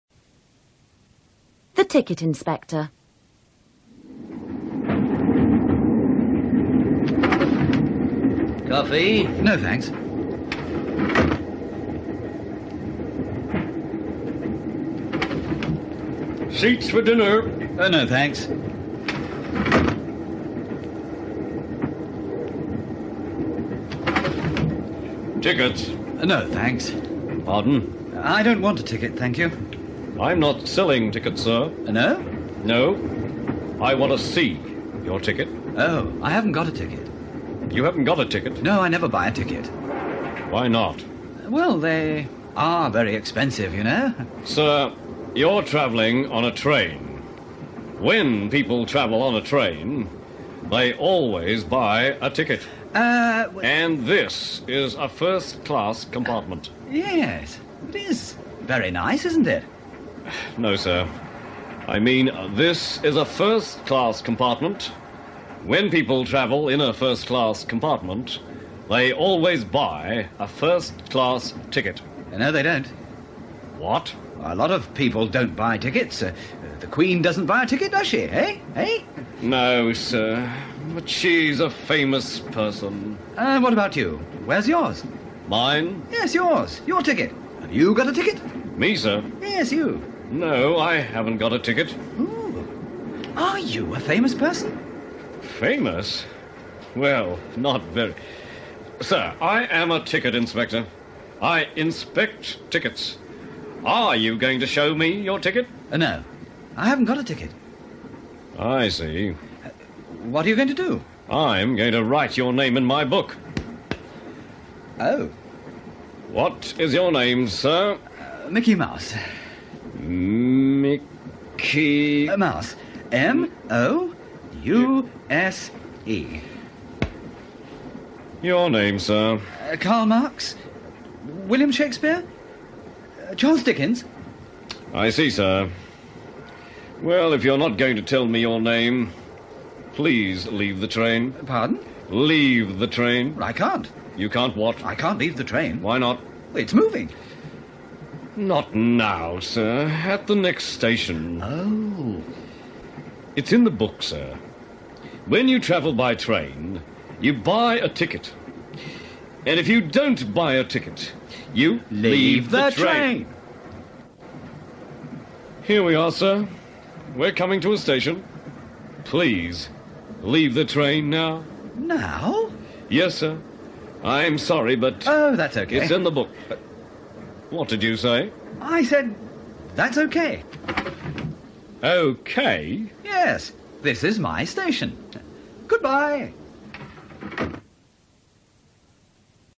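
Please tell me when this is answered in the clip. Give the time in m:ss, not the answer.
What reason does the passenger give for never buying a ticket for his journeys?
0:41.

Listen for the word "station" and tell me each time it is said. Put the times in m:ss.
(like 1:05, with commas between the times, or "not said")
2:30, 2:47, 3:04.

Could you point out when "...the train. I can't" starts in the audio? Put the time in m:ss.
2:22.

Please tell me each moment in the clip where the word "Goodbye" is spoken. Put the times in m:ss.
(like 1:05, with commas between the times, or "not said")
3:05.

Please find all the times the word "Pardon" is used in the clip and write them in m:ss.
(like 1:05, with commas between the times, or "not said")
0:27, 2:21.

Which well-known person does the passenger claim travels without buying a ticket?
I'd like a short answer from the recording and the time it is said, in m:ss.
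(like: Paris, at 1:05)
The Queen, at 1:16.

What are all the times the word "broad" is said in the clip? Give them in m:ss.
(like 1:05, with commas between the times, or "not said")
not said.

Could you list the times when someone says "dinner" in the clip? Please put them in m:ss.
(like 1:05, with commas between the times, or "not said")
0:17.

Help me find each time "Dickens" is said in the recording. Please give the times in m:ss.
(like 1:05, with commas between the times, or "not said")
2:13.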